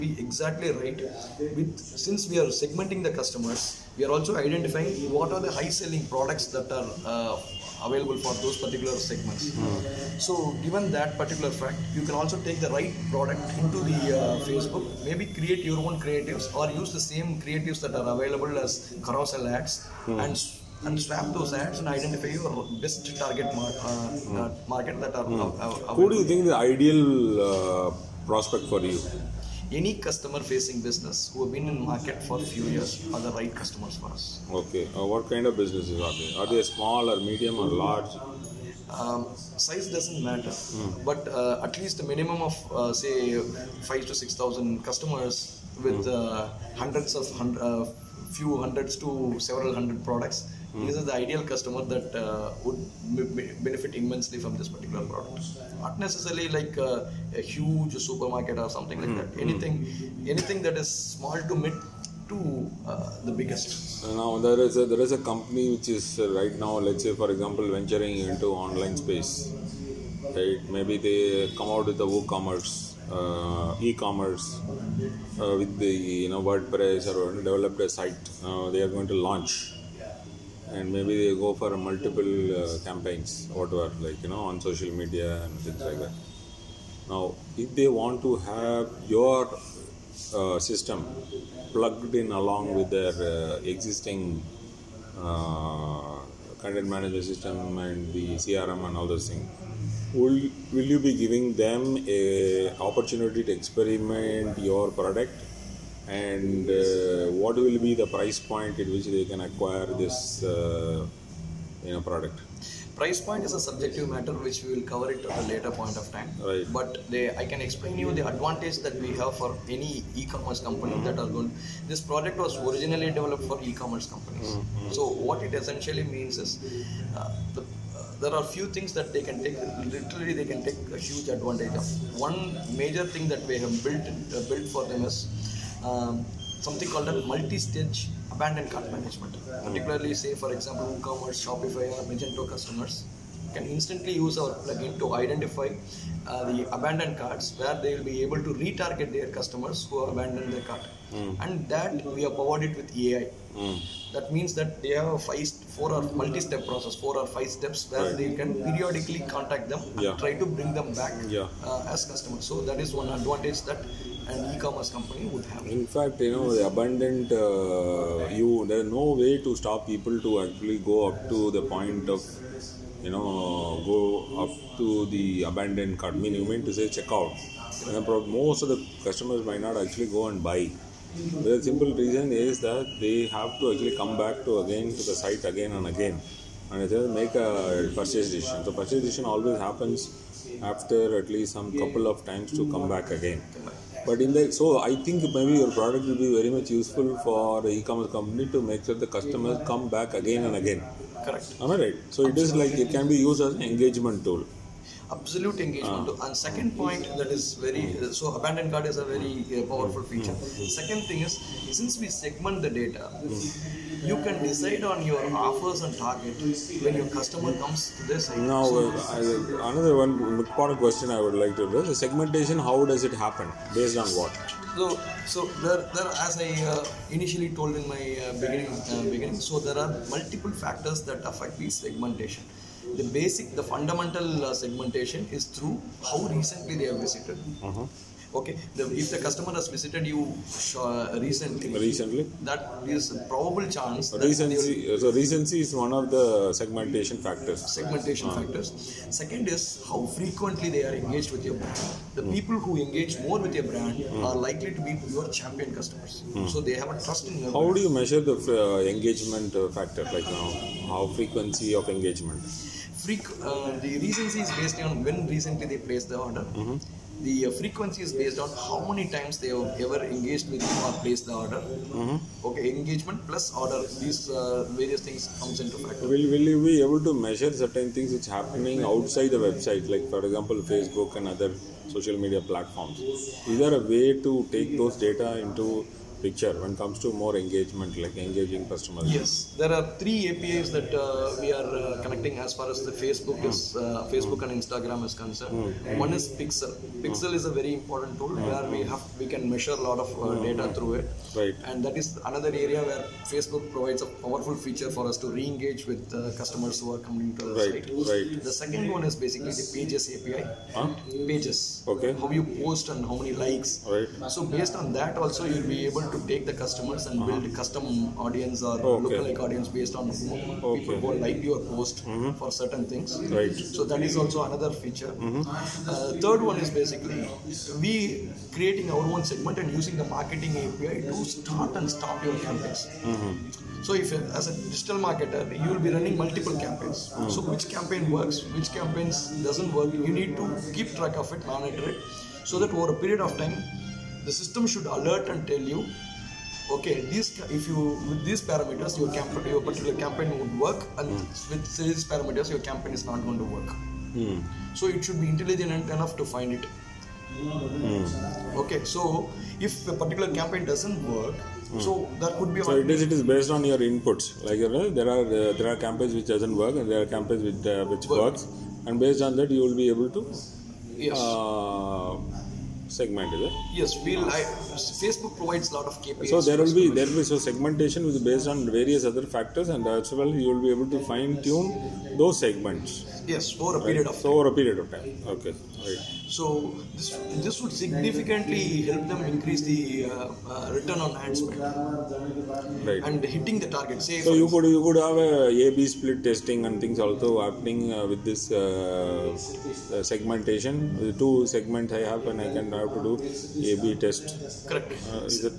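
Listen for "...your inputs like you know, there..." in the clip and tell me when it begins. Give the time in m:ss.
6:03.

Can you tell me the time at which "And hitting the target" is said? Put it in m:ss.
6:33.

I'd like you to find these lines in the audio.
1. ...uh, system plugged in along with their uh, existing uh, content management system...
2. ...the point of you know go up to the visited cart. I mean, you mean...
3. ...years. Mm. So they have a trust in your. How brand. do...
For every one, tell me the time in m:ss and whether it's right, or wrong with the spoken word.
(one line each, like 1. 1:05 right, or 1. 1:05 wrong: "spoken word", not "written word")
1. 1:30 right
2. 2:51 wrong: "abandoned", not "visited"
3. 4:15 wrong: "customers", not "years".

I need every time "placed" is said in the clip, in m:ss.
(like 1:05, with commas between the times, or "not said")
4:25, 4:31.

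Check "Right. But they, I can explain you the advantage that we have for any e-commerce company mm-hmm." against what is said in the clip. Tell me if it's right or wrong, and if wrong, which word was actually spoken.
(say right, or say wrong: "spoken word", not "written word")
right.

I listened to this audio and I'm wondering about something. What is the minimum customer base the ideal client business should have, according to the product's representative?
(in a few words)
5,000 to 6,000 customers.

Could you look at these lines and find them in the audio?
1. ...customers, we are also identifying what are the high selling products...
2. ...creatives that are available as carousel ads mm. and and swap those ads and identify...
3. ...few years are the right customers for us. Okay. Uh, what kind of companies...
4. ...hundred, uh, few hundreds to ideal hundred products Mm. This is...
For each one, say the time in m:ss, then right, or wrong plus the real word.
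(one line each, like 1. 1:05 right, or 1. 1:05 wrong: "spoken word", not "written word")
1. 0:03 right
2. 0:17 right
3. 0:32 wrong: "businesses", not "companies"
4. 0:47 wrong: "several", not "ideal".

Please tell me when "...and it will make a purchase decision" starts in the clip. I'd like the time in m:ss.
3:06.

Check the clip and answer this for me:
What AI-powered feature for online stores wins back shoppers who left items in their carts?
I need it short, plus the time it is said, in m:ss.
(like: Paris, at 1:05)
multi-stage abandoned cart management, at 2:17.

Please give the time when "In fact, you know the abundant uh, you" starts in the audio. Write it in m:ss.
2:45.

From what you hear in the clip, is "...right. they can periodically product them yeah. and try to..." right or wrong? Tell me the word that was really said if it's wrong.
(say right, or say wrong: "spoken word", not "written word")
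wrong: "contact", not "product".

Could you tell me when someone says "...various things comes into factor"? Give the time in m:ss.
4:34.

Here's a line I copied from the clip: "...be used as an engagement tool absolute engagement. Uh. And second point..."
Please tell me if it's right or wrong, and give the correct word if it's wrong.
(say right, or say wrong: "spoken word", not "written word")
right.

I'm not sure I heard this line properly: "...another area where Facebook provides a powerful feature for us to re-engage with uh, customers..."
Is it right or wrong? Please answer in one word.
right.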